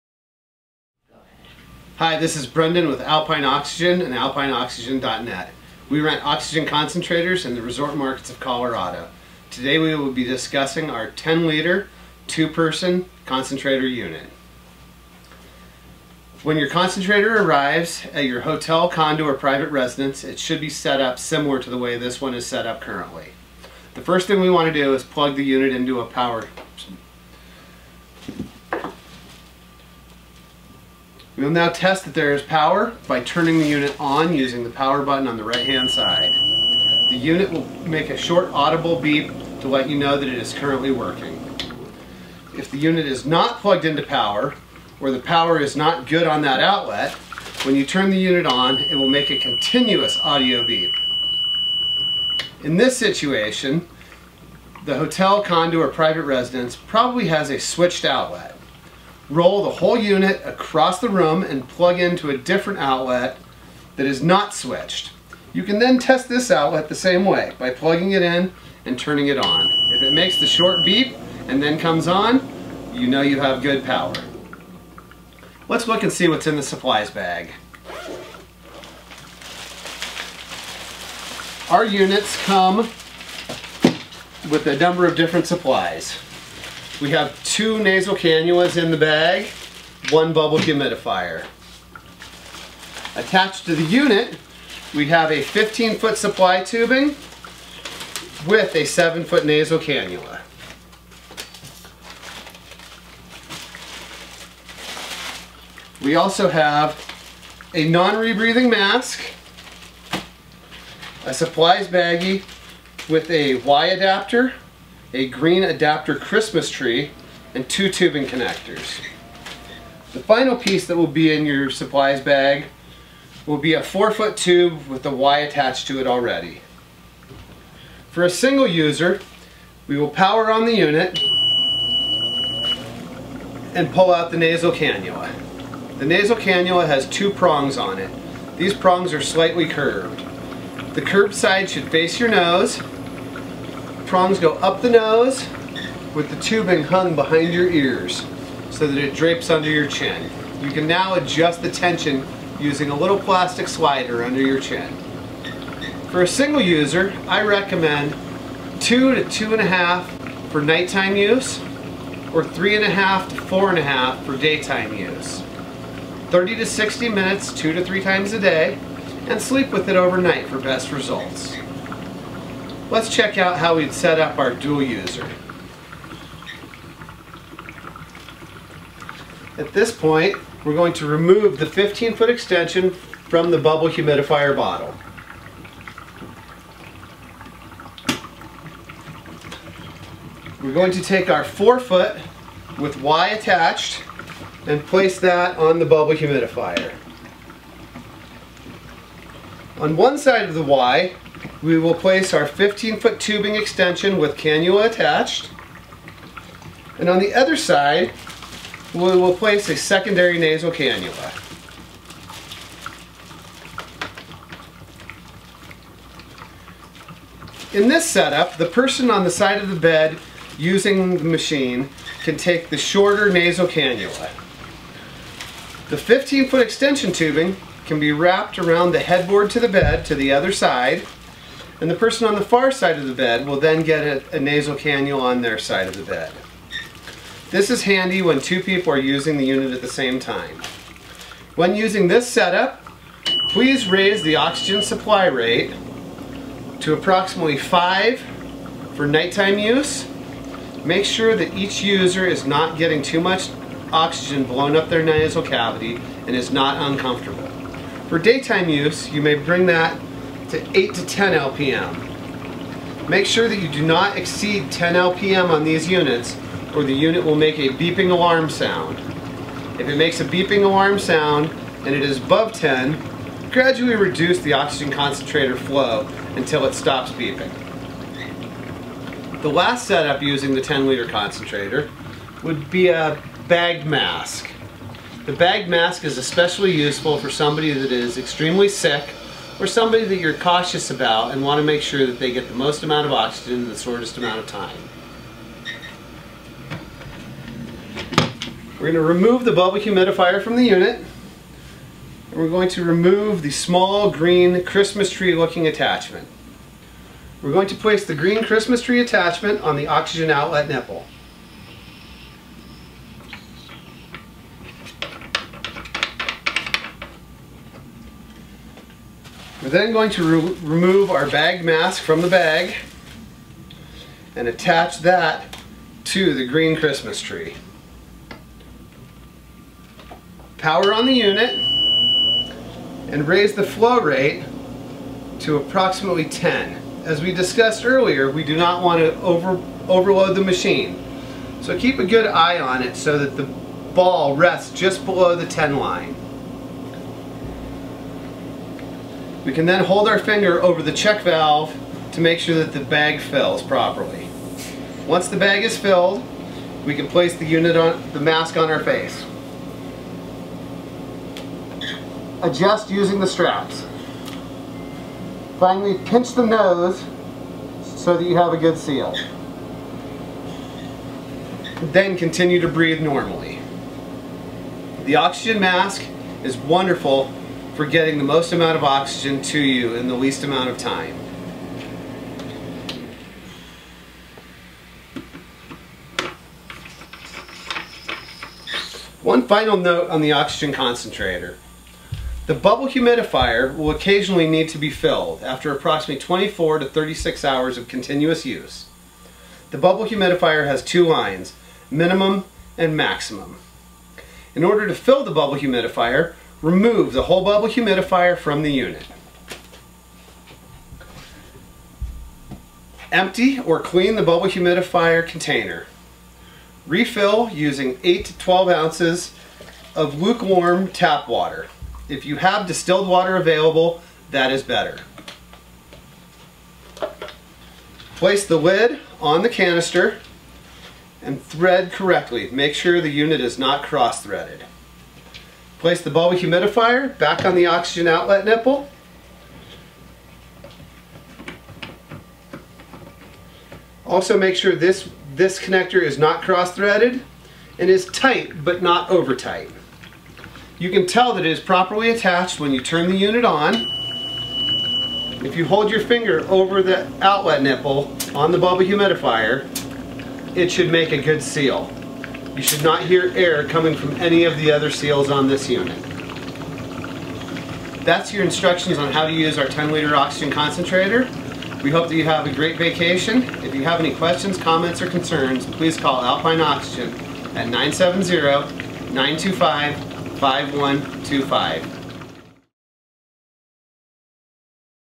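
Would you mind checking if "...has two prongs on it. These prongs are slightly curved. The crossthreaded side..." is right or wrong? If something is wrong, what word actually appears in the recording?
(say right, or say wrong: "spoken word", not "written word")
wrong: "curved", not "crossthreaded".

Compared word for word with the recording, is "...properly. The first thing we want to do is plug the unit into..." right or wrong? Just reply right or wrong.
wrong.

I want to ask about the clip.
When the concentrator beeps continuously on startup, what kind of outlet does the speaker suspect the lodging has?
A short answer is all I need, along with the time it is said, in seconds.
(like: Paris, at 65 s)
switched outlet, at 57 s.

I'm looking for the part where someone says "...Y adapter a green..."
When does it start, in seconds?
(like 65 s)
113 s.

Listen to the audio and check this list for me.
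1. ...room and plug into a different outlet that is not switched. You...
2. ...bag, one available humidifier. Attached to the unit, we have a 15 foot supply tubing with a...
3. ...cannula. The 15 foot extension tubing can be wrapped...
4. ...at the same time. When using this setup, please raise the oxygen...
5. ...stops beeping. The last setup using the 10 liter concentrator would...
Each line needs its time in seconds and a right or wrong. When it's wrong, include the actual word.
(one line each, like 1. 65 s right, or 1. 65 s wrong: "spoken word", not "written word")
1. 61 s right
2. 88 s wrong: "bubble", not "available"
3. 223 s right
4. 239 s right
5. 276 s right.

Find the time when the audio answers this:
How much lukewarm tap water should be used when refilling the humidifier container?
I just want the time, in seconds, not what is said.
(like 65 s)
418 s.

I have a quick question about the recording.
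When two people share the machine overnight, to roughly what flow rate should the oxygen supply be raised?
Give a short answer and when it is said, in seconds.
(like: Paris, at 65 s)
5, at 247 s.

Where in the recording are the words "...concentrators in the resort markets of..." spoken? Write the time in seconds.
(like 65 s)
6 s.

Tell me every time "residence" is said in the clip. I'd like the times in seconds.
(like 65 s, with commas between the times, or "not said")
19 s, 56 s.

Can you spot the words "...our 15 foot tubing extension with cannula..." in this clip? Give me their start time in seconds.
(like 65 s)
202 s.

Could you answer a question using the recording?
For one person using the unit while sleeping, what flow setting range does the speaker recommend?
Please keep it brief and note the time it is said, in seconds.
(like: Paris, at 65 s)
2 to 2.5, at 158 s.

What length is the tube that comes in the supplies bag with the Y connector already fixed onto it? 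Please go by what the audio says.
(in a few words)
4 foot.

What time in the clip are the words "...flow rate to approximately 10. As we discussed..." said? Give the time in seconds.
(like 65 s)
333 s.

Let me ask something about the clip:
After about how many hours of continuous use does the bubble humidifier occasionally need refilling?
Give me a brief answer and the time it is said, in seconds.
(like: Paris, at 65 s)
24 to 36 hours, at 396 s.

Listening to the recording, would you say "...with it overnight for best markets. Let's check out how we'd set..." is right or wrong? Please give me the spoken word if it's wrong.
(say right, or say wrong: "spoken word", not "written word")
wrong: "results", not "markets".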